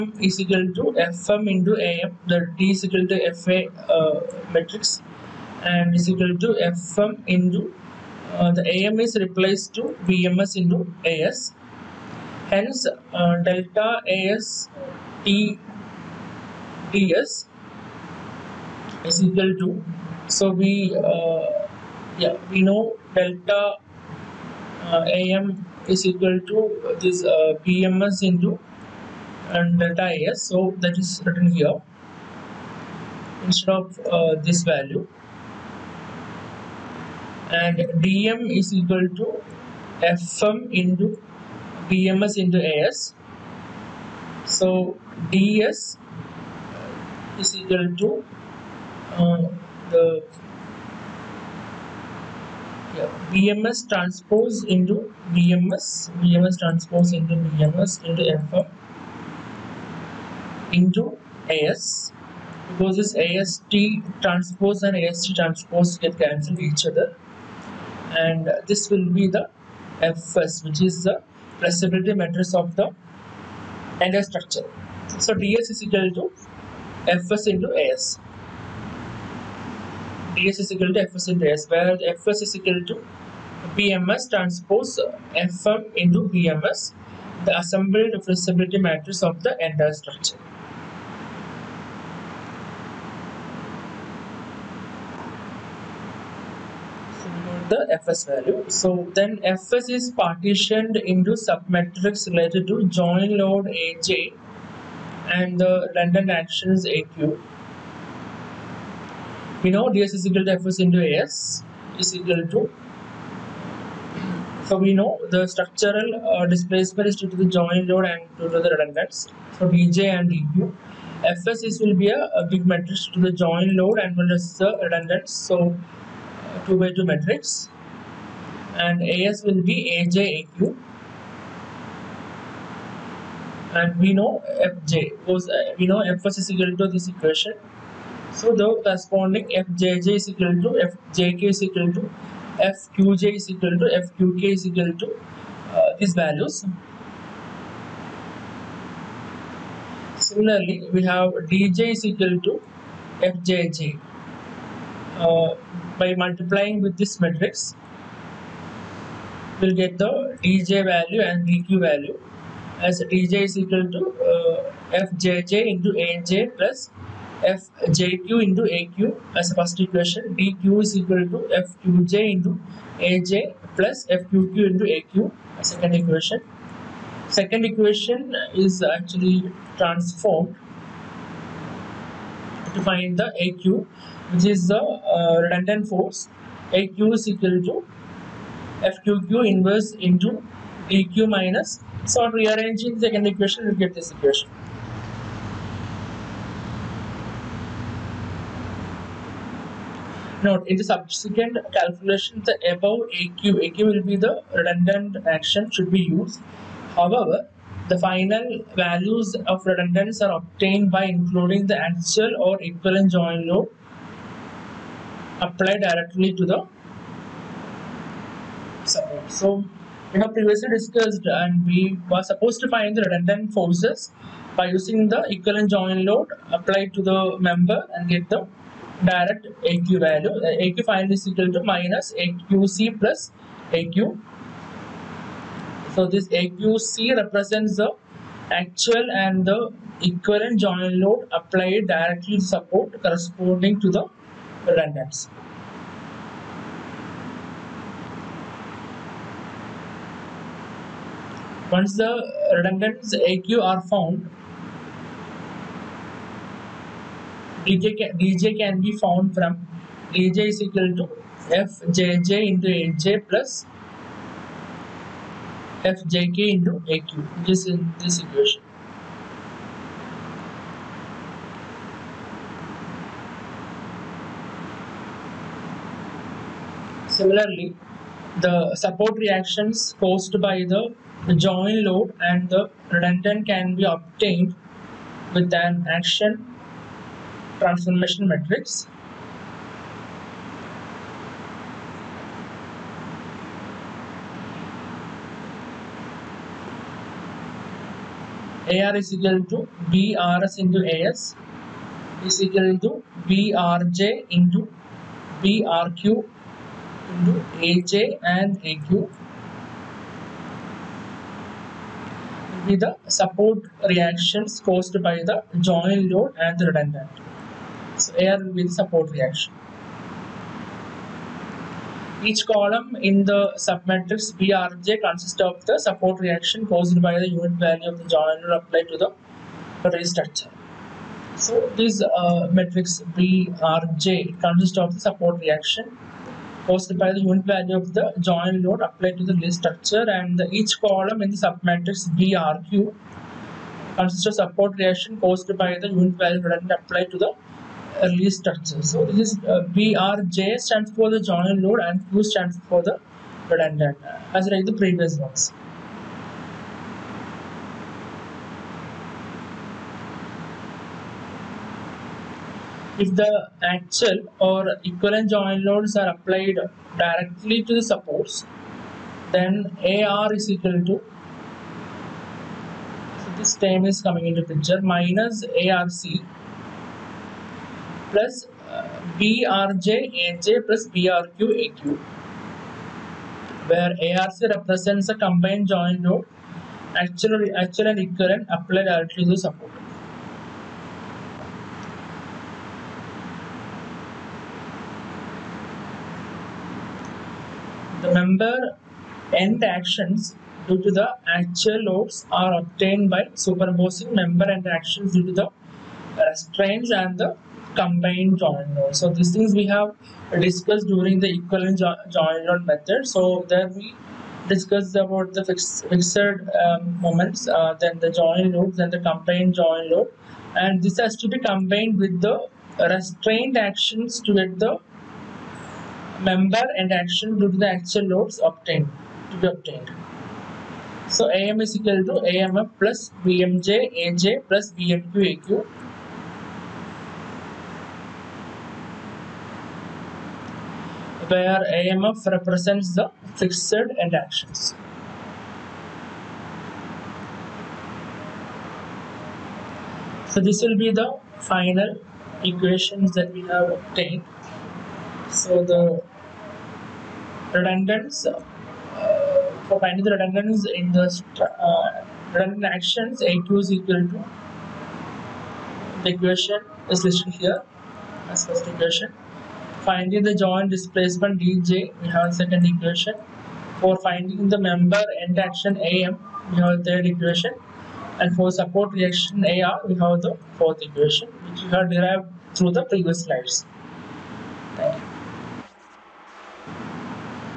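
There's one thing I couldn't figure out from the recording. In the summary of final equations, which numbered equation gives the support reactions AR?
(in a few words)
fourth.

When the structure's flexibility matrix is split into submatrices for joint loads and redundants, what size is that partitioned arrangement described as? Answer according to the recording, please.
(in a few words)
2 by 2.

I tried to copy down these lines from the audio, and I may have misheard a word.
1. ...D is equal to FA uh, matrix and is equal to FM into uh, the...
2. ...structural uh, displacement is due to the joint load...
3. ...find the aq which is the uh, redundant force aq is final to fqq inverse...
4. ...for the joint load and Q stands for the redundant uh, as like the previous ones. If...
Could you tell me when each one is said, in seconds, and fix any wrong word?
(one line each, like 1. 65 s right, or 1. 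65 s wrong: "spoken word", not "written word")
1. 2 s right
2. 115 s right
3. 182 s wrong: "equal", not "final"
4. 350 s right.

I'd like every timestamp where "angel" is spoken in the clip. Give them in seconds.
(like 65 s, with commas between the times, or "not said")
not said.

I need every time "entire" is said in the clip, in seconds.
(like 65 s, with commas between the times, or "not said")
74 s, 89 s.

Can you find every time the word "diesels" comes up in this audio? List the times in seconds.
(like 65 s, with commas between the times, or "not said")
not said.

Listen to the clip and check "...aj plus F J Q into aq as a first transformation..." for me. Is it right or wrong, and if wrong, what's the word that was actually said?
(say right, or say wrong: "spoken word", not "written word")
wrong: "equation", not "transformation".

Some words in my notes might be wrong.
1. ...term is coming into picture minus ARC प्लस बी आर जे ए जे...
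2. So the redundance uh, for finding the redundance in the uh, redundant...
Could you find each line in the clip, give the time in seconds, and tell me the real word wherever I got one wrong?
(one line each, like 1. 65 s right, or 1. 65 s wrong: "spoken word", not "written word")
1. 373 s right
2. 455 s right.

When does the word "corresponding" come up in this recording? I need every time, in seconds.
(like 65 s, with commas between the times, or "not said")
138 s, 243 s.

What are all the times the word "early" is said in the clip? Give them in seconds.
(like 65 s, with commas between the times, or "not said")
348 s.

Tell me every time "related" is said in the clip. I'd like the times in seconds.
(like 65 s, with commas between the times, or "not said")
102 s.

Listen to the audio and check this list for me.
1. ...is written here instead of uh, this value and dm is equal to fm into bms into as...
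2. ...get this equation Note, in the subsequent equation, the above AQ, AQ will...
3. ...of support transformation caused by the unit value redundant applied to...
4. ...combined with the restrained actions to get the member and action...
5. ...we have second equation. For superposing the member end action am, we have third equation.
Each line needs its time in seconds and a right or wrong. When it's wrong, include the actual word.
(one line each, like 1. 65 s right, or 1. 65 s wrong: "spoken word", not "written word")
1. 31 s right
2. 193 s wrong: "calculation", not "equation"
3. 344 s wrong: "reaction", not "transformation"
4. 421 s right
5. 472 s wrong: "finding", not "superposing".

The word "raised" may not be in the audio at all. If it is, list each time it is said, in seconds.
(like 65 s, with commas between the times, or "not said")
329 s, 339 s.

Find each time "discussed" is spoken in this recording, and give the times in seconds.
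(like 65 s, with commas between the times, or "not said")
220 s, 410 s, 414 s.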